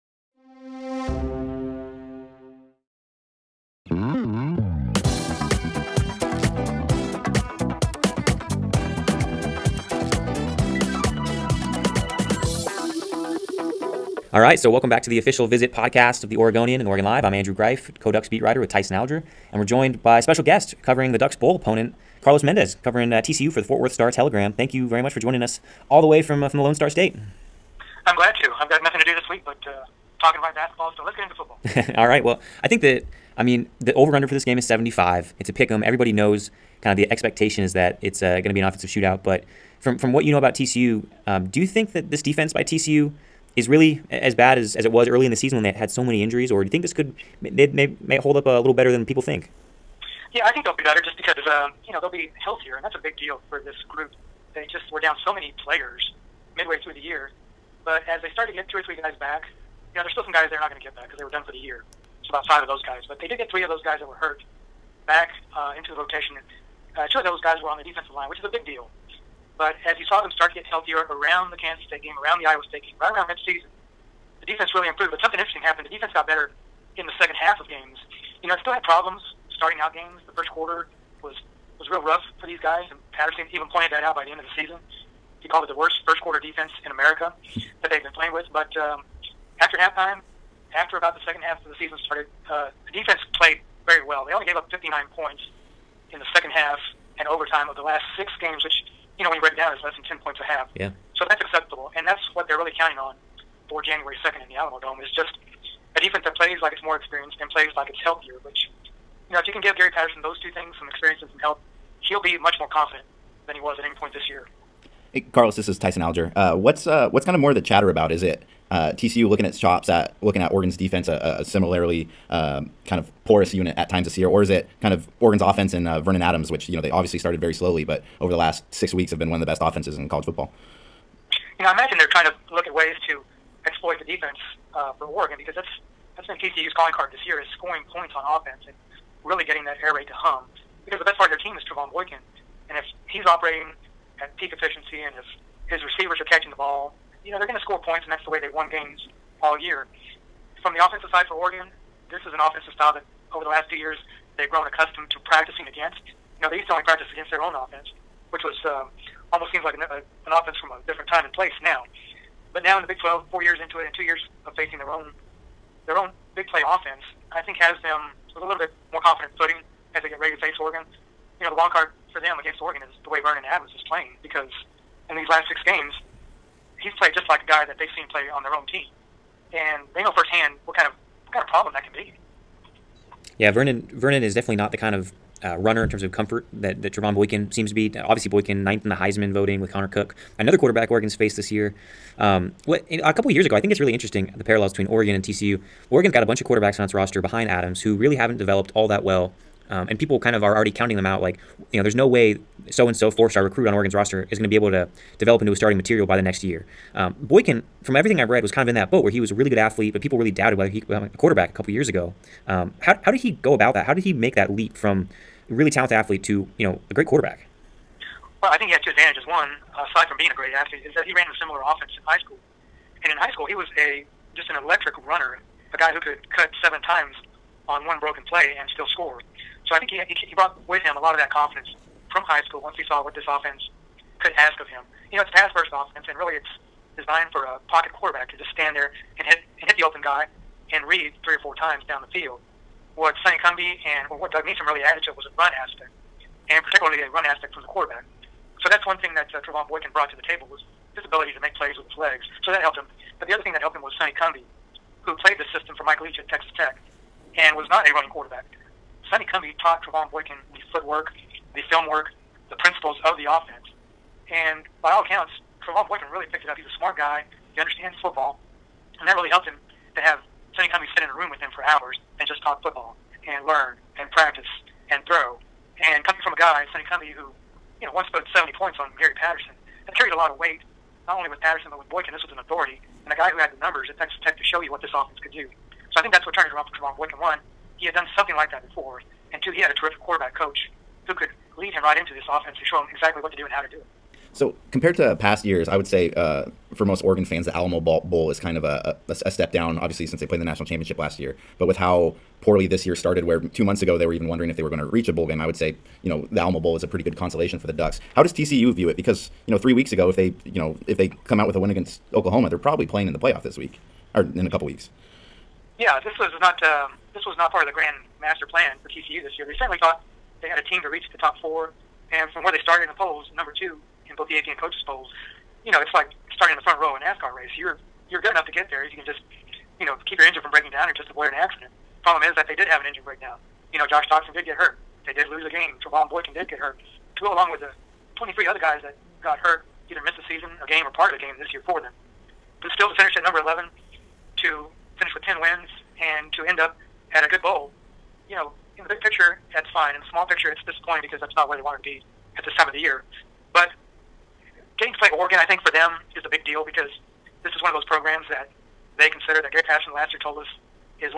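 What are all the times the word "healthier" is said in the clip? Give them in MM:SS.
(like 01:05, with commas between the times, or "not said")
00:52, 01:10, 01:48.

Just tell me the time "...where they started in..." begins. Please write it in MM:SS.
05:22.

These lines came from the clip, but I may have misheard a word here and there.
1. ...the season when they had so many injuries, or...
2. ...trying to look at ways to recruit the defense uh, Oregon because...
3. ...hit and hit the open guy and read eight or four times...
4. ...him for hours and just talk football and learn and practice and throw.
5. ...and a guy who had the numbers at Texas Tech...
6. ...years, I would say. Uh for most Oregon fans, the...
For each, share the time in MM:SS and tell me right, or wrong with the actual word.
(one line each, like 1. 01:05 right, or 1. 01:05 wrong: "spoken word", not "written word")
1. 00:45 right
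2. 02:12 wrong: "exploit", not "recruit"
3. 03:59 wrong: "three", not "eight"
4. 04:31 right
5. 04:43 right
6. 04:55 right.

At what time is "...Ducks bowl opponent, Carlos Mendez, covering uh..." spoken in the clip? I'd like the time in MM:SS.
00:21.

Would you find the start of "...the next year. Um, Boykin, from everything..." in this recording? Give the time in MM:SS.
03:26.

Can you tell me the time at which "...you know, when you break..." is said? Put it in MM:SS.
01:39.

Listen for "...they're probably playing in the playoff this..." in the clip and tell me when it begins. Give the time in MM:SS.
05:12.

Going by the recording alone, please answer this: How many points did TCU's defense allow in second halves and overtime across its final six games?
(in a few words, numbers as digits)
59.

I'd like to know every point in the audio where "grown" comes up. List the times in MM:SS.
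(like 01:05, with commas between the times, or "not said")
02:34.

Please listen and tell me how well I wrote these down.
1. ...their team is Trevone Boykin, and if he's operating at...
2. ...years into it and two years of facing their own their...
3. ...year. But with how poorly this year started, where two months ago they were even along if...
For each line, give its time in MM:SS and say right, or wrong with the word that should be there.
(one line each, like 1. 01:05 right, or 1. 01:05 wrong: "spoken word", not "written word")
1. 02:21 right
2. 02:43 right
3. 05:01 wrong: "wondering", not "along".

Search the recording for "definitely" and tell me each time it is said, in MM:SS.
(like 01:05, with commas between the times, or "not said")
03:04.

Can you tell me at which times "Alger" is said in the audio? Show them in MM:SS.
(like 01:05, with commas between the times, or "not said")
00:18, 01:56.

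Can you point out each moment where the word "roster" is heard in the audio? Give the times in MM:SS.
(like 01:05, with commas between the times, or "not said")
03:16, 03:23.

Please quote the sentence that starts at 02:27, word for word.
You know, they're going to score points, and that's the way they've won games all year.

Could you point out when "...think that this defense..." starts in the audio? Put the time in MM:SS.
00:41.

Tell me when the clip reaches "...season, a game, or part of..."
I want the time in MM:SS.
05:40.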